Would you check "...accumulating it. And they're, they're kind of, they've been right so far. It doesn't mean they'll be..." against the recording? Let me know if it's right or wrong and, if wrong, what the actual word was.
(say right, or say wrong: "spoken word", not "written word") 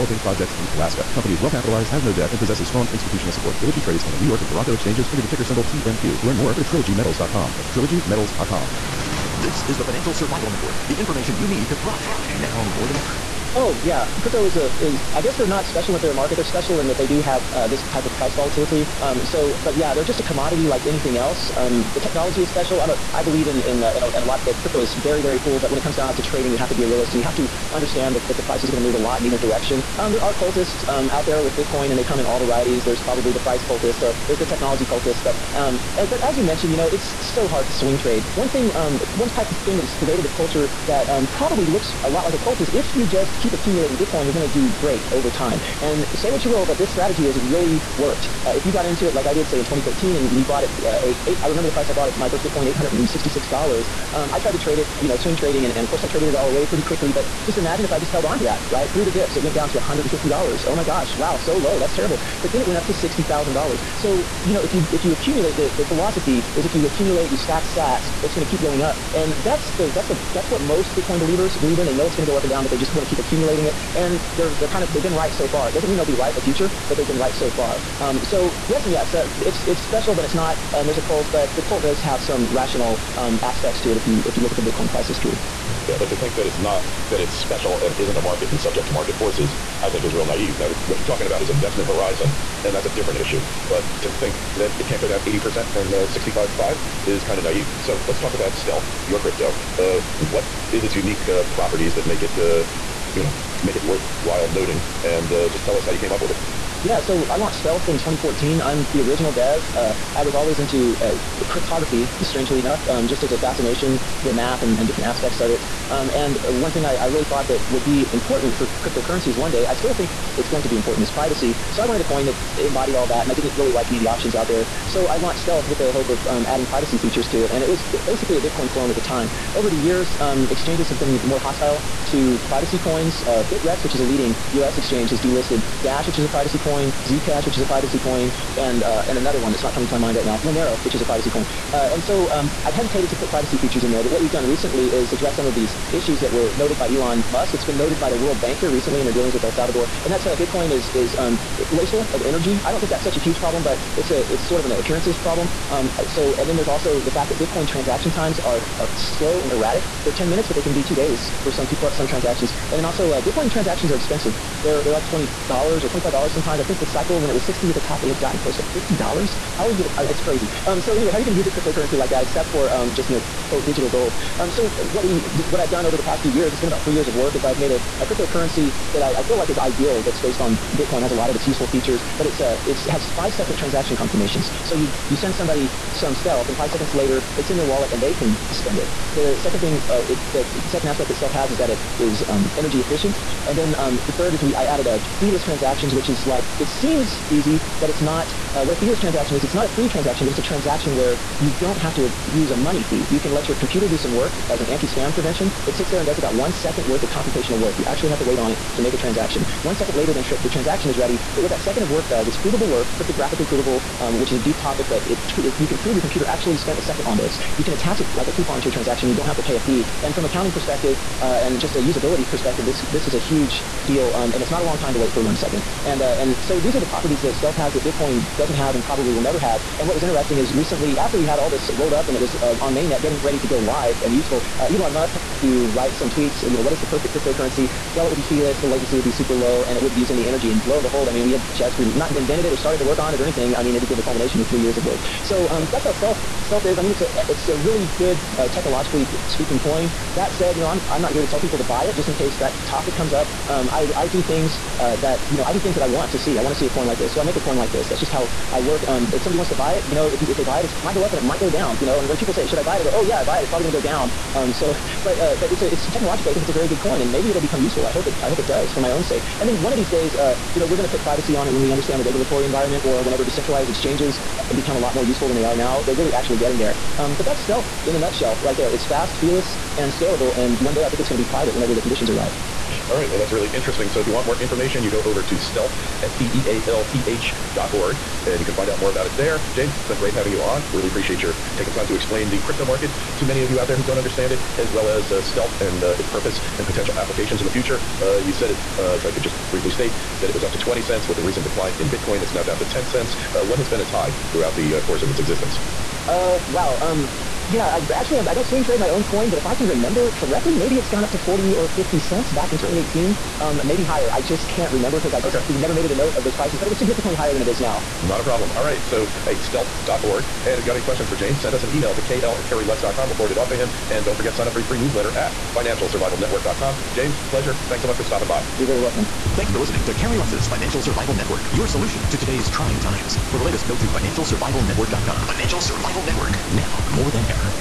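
right.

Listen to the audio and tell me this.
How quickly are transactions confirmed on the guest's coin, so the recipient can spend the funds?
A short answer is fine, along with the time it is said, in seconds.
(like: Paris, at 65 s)
5 seconds, at 183 s.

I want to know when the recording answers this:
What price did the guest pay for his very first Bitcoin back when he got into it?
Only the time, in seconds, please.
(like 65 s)
52 s.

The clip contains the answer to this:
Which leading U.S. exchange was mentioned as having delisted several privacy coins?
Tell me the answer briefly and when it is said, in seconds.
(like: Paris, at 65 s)
Bittrex, at 133 s.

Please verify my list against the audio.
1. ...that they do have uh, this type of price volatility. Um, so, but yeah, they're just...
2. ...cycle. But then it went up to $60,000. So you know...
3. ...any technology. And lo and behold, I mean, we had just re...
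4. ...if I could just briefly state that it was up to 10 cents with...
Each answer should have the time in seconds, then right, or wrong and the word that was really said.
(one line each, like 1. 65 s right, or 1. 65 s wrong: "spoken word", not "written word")
1. 16 s right
2. 61 s wrong: "terrible", not "cycle"
3. 240 s wrong: "energy", not "technology"
4. 298 s wrong: "20", not "10".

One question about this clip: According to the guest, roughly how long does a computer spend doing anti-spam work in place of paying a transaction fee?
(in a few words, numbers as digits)
1 second.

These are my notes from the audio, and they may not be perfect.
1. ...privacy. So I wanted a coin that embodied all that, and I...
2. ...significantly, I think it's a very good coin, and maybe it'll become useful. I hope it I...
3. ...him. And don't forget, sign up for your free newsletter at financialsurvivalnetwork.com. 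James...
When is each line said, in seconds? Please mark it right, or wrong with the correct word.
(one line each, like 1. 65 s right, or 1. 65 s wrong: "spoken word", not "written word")
1. 121 s right
2. 265 s wrong: "technologically", not "significantly"
3. 323 s right.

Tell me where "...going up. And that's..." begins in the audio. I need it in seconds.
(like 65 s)
68 s.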